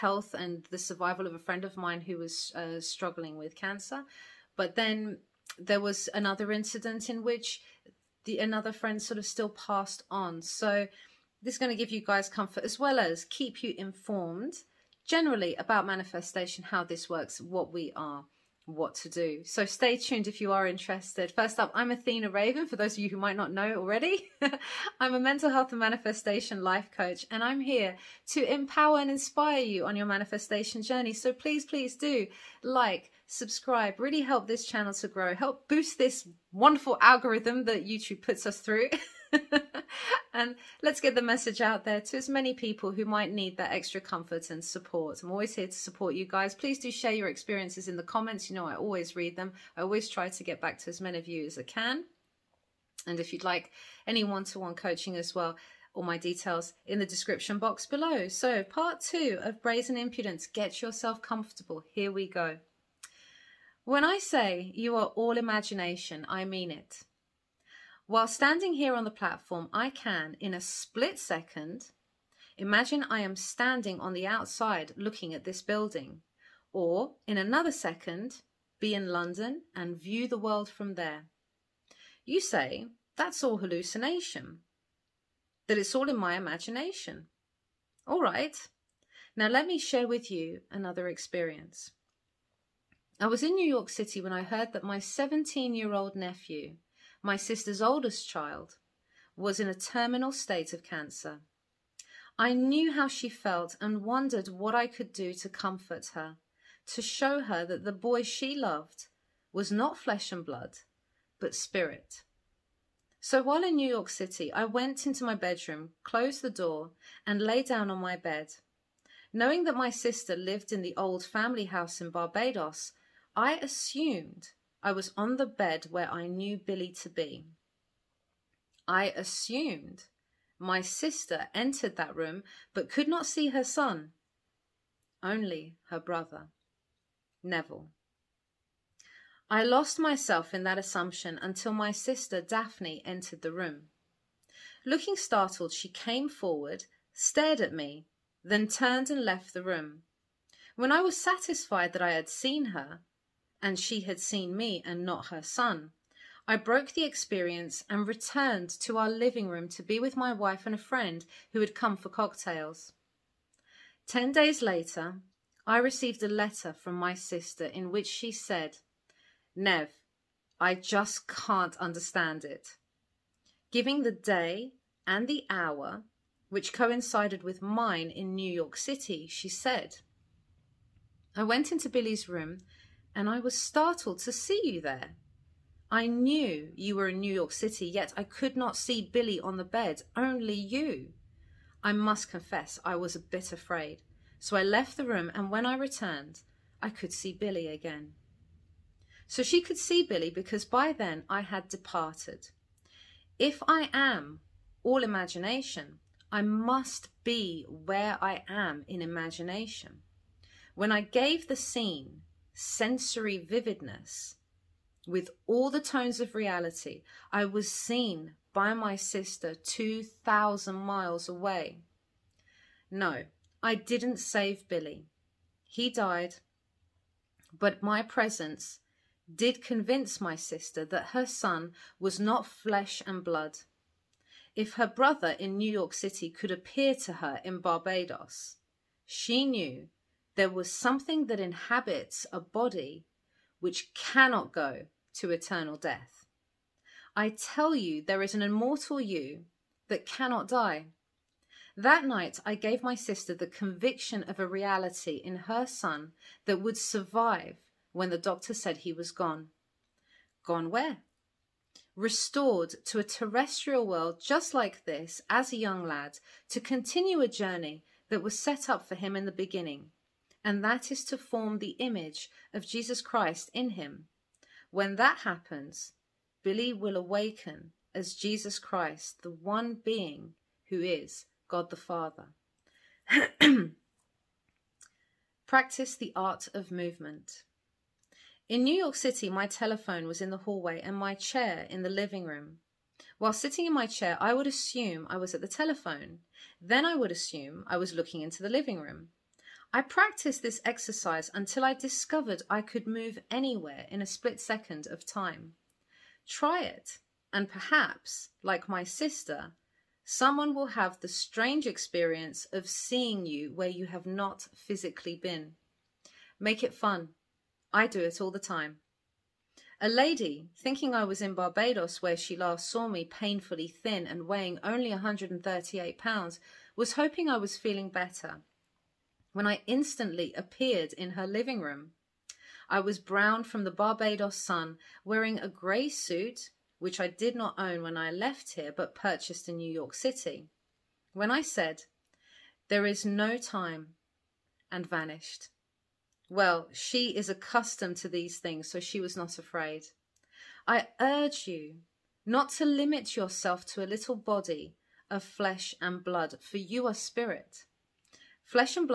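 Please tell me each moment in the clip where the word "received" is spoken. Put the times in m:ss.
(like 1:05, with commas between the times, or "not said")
2:45.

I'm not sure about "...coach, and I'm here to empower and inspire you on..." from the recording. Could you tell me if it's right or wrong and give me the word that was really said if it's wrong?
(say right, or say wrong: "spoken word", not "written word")
right.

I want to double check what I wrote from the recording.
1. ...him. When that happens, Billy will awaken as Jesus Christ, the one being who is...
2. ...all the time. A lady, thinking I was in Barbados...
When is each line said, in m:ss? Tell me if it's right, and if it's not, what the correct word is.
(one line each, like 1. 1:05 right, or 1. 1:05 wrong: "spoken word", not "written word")
1. 4:33 right
2. 5:18 right.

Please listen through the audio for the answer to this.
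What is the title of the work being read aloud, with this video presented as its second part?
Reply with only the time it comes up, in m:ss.
0:59.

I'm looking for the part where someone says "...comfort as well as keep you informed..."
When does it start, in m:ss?
0:12.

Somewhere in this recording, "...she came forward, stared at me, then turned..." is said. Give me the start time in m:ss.
2:25.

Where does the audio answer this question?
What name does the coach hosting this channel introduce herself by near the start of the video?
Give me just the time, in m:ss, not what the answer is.
0:21.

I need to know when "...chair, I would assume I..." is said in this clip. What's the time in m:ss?
4:53.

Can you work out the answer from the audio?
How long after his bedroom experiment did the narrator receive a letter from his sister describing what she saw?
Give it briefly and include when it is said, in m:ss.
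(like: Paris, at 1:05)
10 days, at 2:44.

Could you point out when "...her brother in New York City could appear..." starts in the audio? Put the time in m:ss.
3:54.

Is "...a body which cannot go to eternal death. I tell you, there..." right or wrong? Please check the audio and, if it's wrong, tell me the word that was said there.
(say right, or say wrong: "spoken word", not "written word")
right.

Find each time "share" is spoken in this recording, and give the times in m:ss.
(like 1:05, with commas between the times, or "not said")
0:46, 1:29.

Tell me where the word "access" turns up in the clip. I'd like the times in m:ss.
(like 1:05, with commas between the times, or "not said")
not said.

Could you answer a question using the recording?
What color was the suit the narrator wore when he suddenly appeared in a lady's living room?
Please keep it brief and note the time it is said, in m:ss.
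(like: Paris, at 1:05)
Grey, at 5:35.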